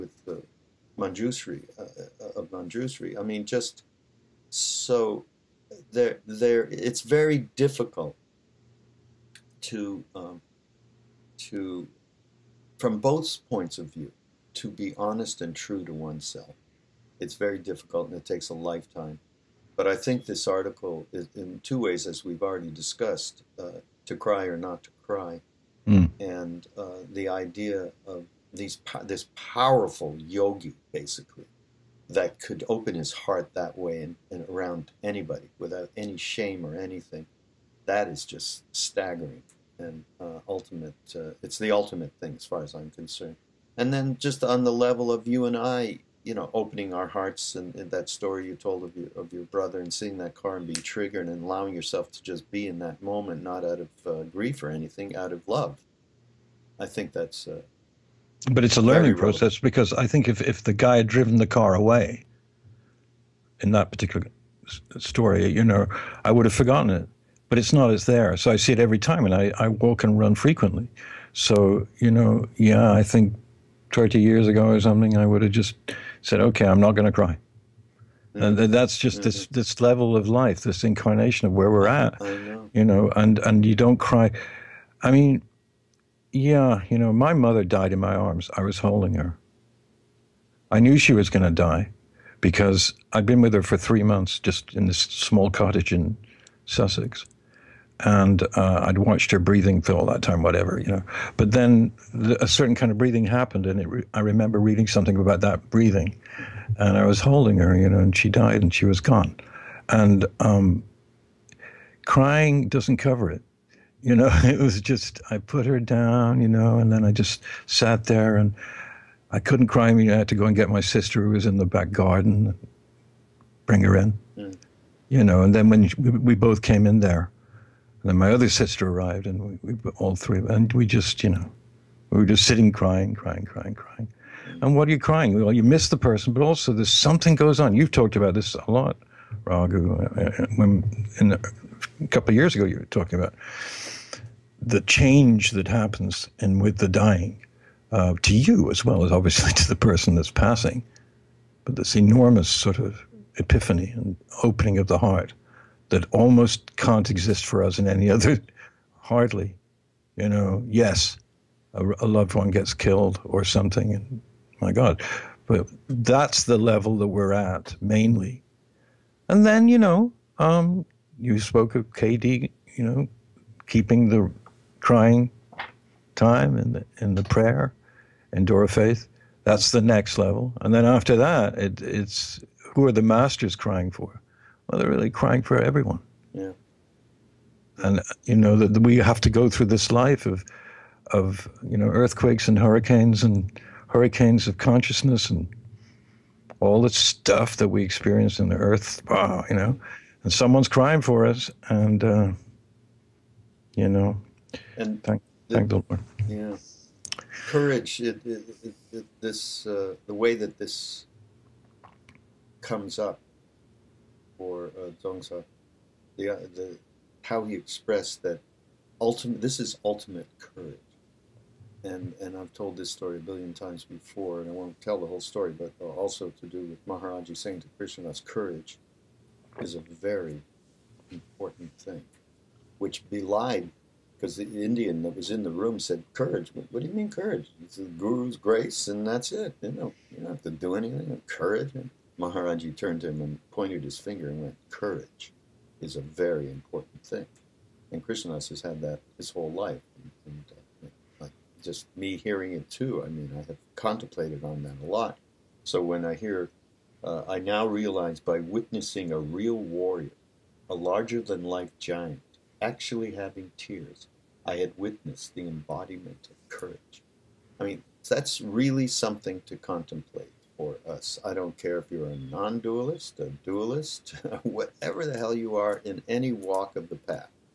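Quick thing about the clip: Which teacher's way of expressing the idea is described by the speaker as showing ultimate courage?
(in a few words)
Dzongsar.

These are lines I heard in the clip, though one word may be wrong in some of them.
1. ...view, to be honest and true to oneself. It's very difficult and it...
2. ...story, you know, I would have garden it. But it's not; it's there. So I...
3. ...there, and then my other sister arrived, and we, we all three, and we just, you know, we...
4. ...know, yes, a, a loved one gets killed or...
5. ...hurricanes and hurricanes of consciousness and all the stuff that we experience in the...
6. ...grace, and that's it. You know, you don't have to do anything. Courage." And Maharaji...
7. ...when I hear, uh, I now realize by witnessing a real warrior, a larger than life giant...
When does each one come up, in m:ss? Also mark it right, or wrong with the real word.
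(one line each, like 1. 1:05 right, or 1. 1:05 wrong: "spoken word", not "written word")
1. 0:13 right
2. 1:04 wrong: "forgotten", not "garden"
3. 2:06 right
4. 2:40 right
5. 3:12 right
6. 3:58 right
7. 4:15 right.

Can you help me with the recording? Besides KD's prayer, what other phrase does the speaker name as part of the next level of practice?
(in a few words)
door of Faith.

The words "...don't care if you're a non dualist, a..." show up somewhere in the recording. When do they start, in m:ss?
4:31.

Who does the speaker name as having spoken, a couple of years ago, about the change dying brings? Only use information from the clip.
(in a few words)
Raghu.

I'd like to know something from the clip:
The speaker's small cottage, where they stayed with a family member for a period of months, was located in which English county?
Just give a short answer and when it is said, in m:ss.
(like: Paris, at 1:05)
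Sussex, at 1:36.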